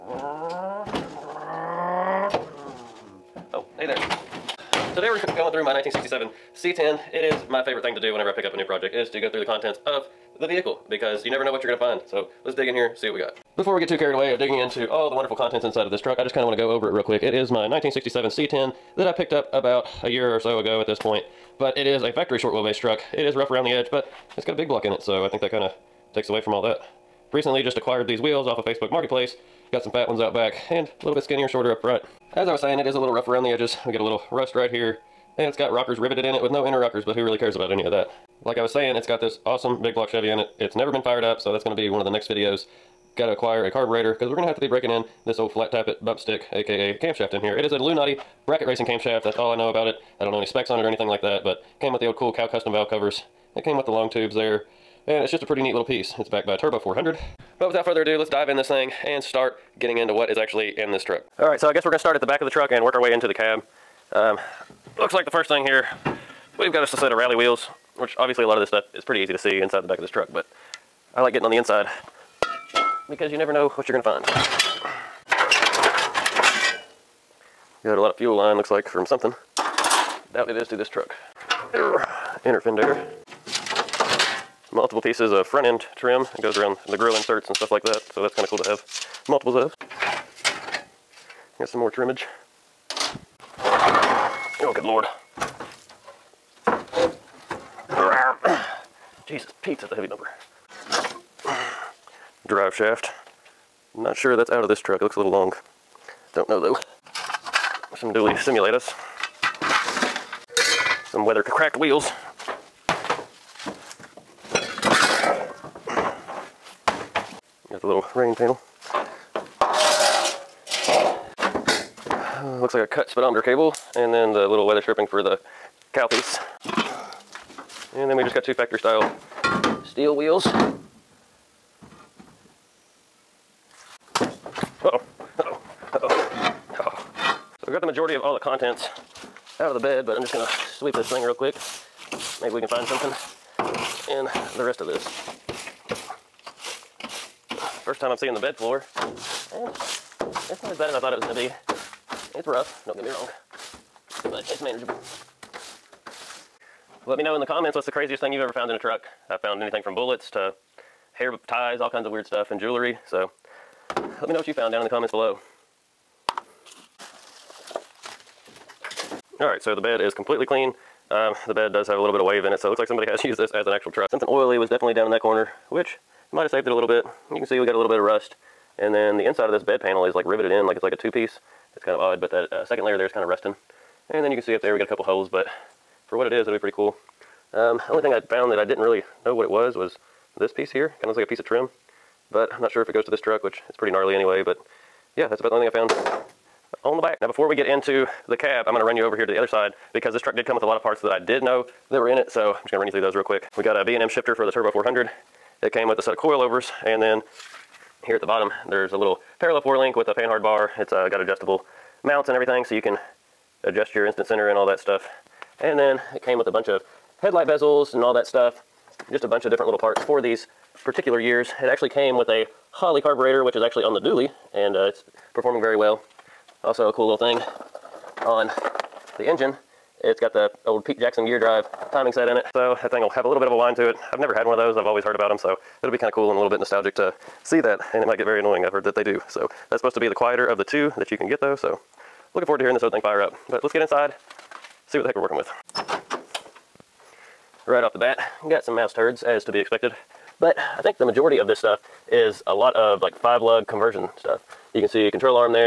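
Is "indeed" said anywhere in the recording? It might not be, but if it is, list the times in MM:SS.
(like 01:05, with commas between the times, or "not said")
not said.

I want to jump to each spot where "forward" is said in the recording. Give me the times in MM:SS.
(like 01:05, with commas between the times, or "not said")
04:02.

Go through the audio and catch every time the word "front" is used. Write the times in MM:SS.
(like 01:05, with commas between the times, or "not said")
00:31, 01:25.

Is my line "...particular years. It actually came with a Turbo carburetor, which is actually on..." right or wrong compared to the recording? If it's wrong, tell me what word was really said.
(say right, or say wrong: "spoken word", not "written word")
wrong: "Holley", not "Turbo".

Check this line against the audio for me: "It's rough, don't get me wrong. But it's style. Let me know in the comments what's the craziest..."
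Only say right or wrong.
wrong.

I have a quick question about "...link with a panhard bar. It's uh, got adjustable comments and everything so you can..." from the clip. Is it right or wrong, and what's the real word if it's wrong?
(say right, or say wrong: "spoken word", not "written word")
wrong: "mounts", not "comments".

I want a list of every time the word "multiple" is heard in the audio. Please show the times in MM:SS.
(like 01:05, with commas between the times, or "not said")
01:24, 01:29.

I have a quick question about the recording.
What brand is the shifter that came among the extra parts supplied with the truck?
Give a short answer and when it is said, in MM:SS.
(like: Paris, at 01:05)
B&M, at 03:23.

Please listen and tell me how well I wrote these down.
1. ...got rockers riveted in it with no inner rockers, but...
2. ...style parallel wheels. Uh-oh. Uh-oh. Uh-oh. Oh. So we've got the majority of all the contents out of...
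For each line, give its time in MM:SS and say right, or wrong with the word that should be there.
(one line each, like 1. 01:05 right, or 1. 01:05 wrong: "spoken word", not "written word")
1. 00:35 right
2. 02:08 wrong: "steel", not "parallel".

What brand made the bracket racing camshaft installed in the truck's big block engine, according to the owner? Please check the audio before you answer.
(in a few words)
Lunati.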